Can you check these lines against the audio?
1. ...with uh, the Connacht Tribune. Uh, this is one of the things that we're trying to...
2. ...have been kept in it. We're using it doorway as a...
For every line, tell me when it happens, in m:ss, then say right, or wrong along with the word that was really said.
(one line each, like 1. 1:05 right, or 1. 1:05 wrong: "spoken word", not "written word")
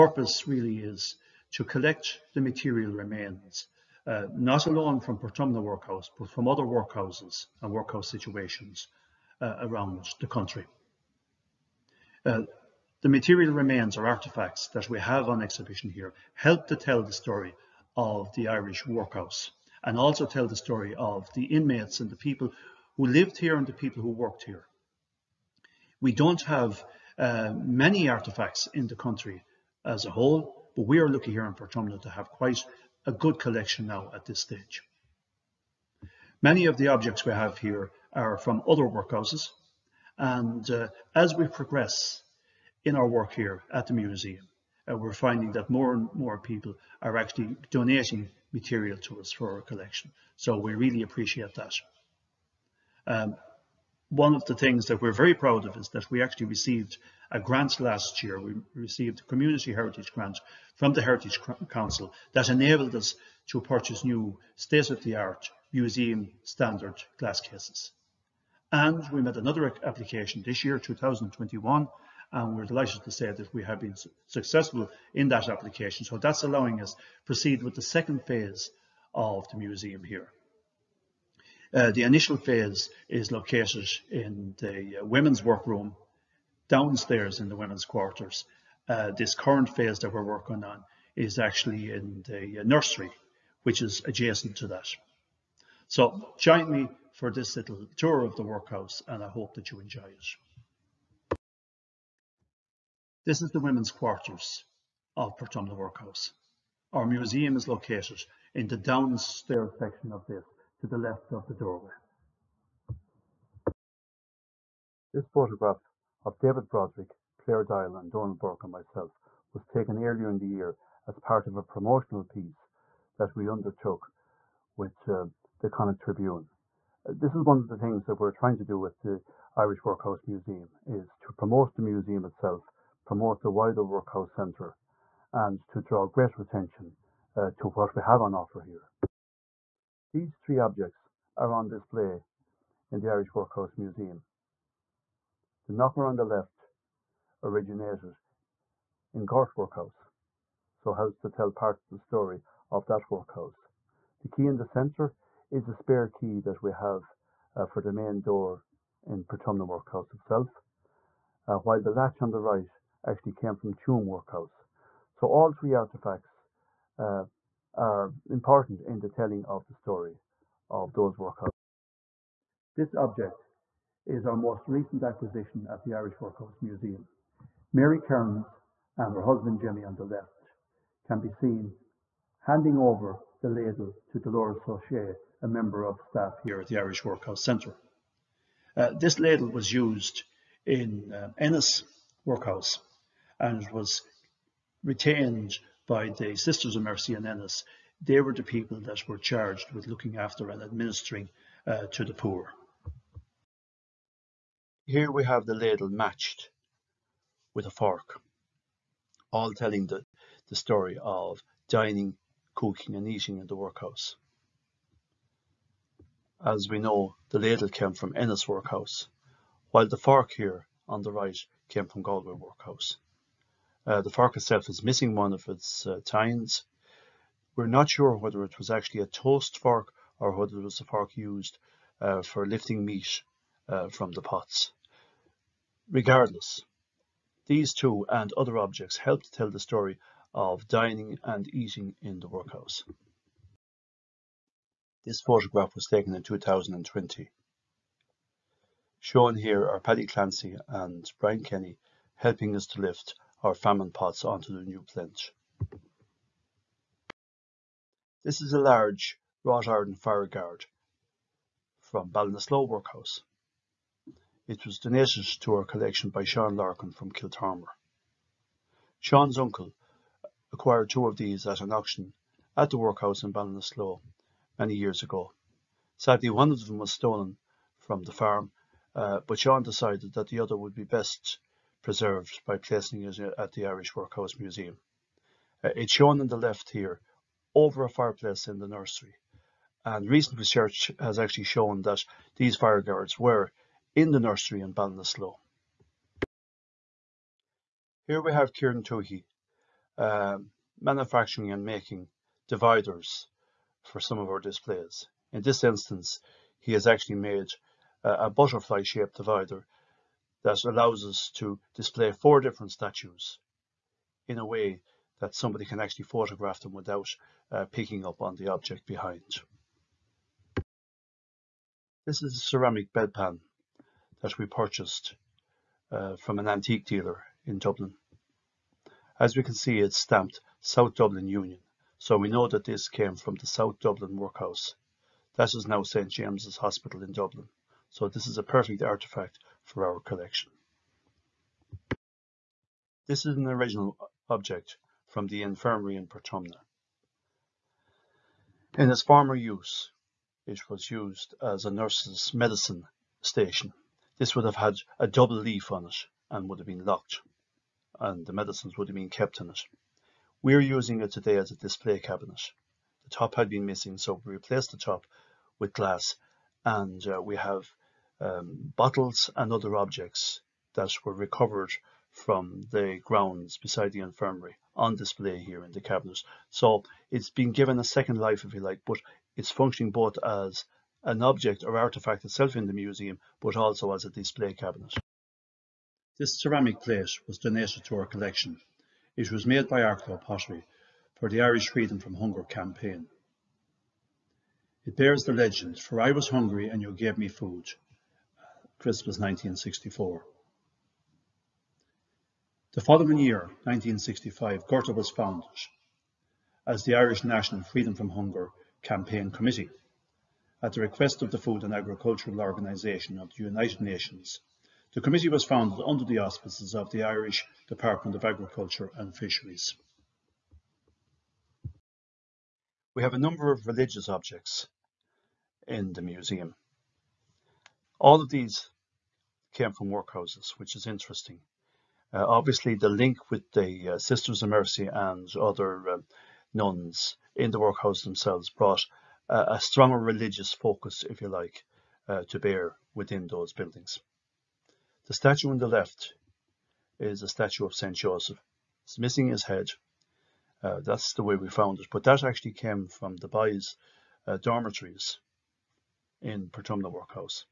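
1. 2:04 right
2. 5:58 wrong: "today", not "doorway".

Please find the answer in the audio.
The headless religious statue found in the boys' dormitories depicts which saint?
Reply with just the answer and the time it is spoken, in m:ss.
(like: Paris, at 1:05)
Saint Joseph, at 7:27.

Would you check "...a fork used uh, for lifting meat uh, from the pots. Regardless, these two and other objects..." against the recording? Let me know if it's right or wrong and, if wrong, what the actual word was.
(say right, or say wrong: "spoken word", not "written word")
right.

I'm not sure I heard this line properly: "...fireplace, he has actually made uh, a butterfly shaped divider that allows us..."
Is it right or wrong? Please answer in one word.
wrong.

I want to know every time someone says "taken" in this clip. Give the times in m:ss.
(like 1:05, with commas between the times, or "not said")
1:59, 4:05.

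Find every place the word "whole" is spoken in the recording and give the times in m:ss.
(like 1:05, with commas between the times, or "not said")
0:30.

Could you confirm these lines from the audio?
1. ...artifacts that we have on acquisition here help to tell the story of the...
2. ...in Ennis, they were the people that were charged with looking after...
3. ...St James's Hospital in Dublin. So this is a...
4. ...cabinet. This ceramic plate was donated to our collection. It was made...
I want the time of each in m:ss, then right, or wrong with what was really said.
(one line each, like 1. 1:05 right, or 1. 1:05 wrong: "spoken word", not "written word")
1. 0:14 wrong: "exhibition", not "acquisition"
2. 3:17 right
3. 5:35 right
4. 6:24 right.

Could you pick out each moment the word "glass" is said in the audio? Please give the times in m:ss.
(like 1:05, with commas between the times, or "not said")
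1:07, 6:05.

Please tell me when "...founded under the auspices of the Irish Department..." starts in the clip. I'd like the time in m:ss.
6:55.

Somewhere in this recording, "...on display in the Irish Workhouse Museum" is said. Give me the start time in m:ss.
2:21.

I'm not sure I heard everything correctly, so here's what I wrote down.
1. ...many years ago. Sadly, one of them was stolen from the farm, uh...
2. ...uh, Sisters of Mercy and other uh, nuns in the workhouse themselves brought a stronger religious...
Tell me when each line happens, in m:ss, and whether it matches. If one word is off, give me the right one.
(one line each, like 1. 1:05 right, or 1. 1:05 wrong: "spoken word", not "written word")
1. 4:34 right
2. 7:13 right.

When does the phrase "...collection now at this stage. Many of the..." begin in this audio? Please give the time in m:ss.
0:33.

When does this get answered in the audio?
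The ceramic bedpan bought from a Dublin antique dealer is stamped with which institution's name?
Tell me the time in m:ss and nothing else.
5:30.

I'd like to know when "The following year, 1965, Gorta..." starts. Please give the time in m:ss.
6:42.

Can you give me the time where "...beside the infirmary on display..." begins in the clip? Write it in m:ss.
6:13.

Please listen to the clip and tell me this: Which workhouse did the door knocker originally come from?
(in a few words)
Gort Workhouse.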